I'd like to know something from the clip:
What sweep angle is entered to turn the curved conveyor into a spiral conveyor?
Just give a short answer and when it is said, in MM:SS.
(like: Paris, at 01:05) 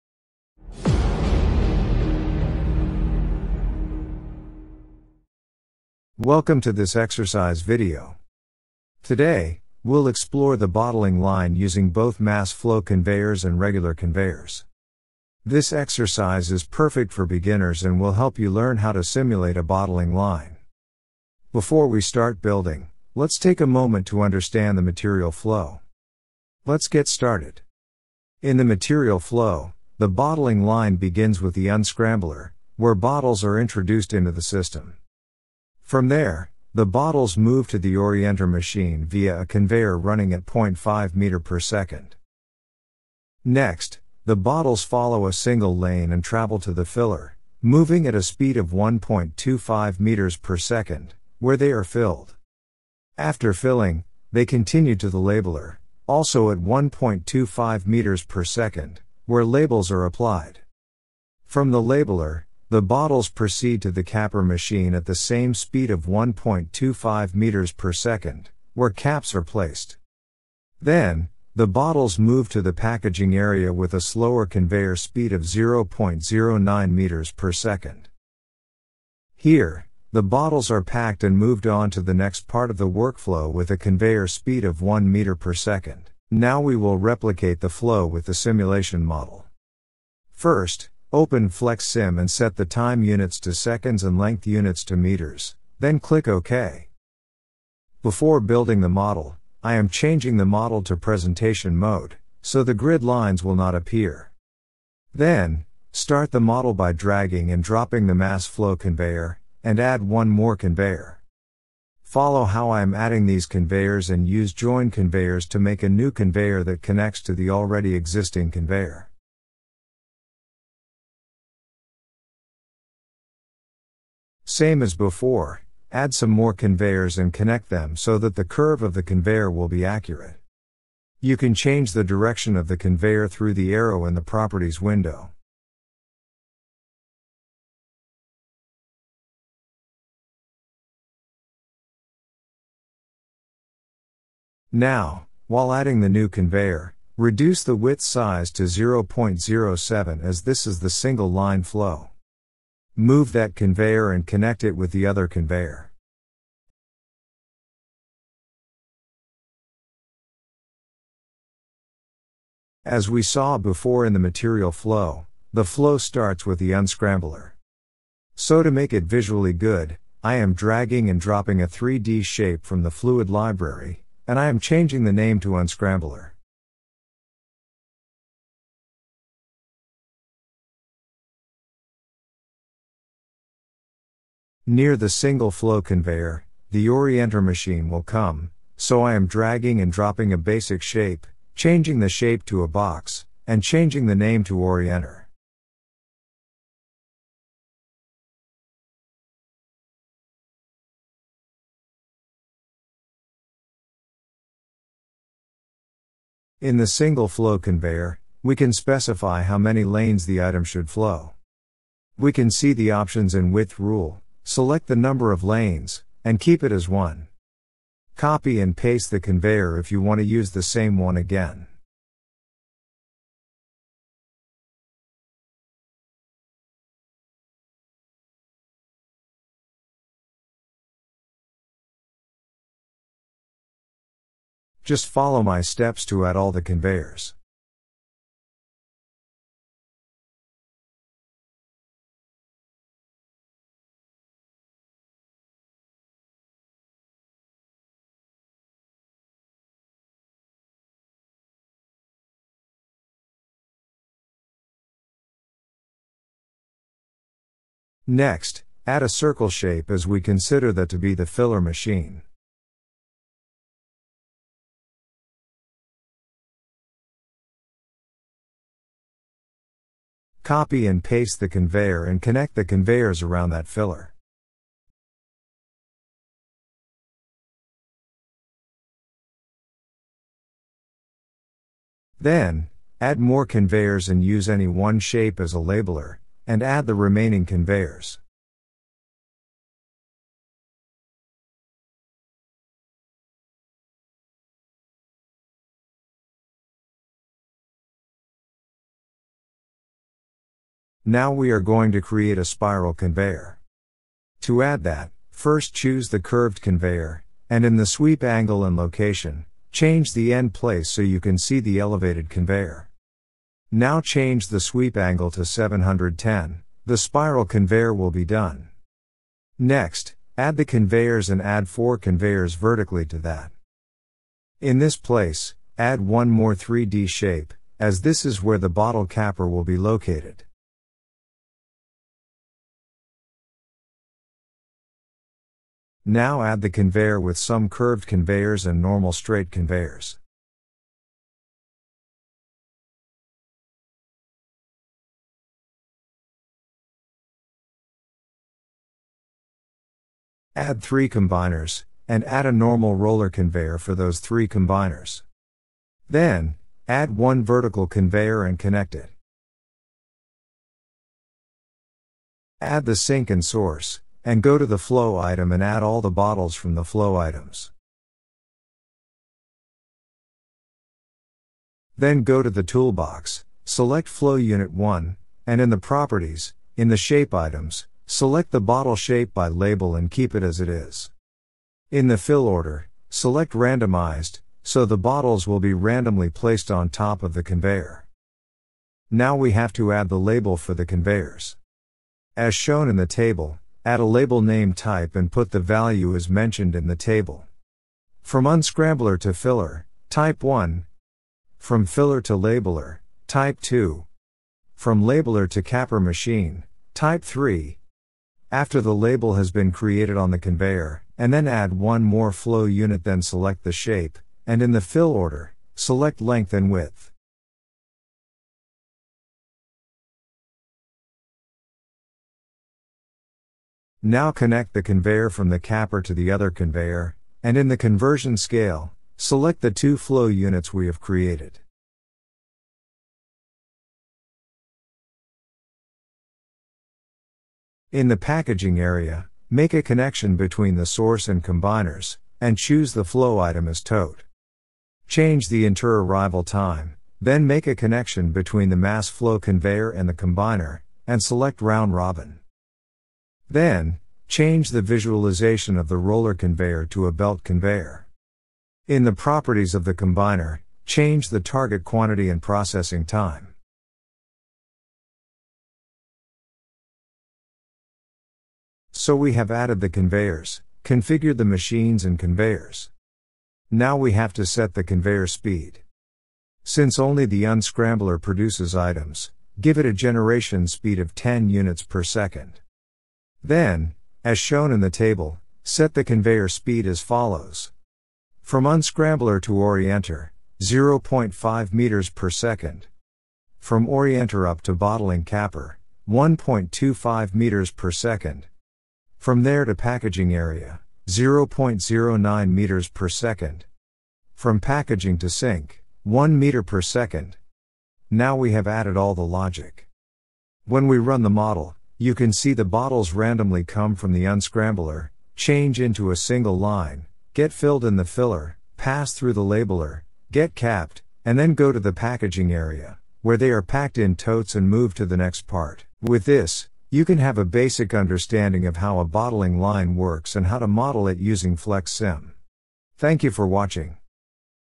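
710, at 05:15.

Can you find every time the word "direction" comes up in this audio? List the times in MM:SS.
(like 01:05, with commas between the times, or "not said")
02:12.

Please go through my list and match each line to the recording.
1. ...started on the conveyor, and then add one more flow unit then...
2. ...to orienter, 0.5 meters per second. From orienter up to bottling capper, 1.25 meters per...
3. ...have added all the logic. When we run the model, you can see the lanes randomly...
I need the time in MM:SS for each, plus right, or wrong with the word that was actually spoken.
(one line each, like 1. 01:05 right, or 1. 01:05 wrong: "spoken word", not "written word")
1. 06:49 wrong: "created", not "started"
2. 08:09 right
3. 08:28 wrong: "bottles", not "lanes".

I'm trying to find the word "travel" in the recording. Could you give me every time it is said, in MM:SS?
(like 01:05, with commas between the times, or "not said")
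00:46.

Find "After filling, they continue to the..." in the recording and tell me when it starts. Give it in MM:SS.
00:53.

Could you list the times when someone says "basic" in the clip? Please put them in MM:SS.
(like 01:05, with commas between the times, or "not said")
03:10, 08:47.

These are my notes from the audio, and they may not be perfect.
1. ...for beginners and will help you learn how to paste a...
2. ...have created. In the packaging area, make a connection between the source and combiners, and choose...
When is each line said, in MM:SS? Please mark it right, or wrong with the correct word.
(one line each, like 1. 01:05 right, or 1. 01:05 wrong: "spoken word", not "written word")
1. 00:17 wrong: "simulate", not "paste"
2. 07:10 right.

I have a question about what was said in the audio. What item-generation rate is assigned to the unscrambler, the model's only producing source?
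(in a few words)
10 units per second.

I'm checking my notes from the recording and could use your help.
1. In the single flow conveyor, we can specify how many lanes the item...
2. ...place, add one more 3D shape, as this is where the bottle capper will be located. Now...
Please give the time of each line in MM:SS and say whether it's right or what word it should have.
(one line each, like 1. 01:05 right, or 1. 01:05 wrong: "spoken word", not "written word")
1. 03:26 right
2. 05:24 right.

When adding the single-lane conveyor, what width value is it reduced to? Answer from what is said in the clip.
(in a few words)
0.07.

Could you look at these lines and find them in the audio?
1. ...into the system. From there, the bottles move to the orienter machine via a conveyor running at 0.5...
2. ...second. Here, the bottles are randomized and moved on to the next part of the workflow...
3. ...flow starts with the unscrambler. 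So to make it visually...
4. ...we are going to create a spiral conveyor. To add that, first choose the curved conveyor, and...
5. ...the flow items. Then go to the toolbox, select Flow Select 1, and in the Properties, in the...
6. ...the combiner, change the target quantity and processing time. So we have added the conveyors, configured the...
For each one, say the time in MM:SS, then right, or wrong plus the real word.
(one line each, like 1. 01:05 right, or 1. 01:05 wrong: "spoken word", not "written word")
1. 00:34 right
2. 01:17 wrong: "packed", not "randomized"
3. 02:45 right
4. 05:01 right
5. 06:06 wrong: "Unit", not "Select"
6. 07:39 right.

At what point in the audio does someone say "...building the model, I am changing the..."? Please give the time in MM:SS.
01:38.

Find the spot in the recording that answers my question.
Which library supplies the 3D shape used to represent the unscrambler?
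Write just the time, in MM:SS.
02:52.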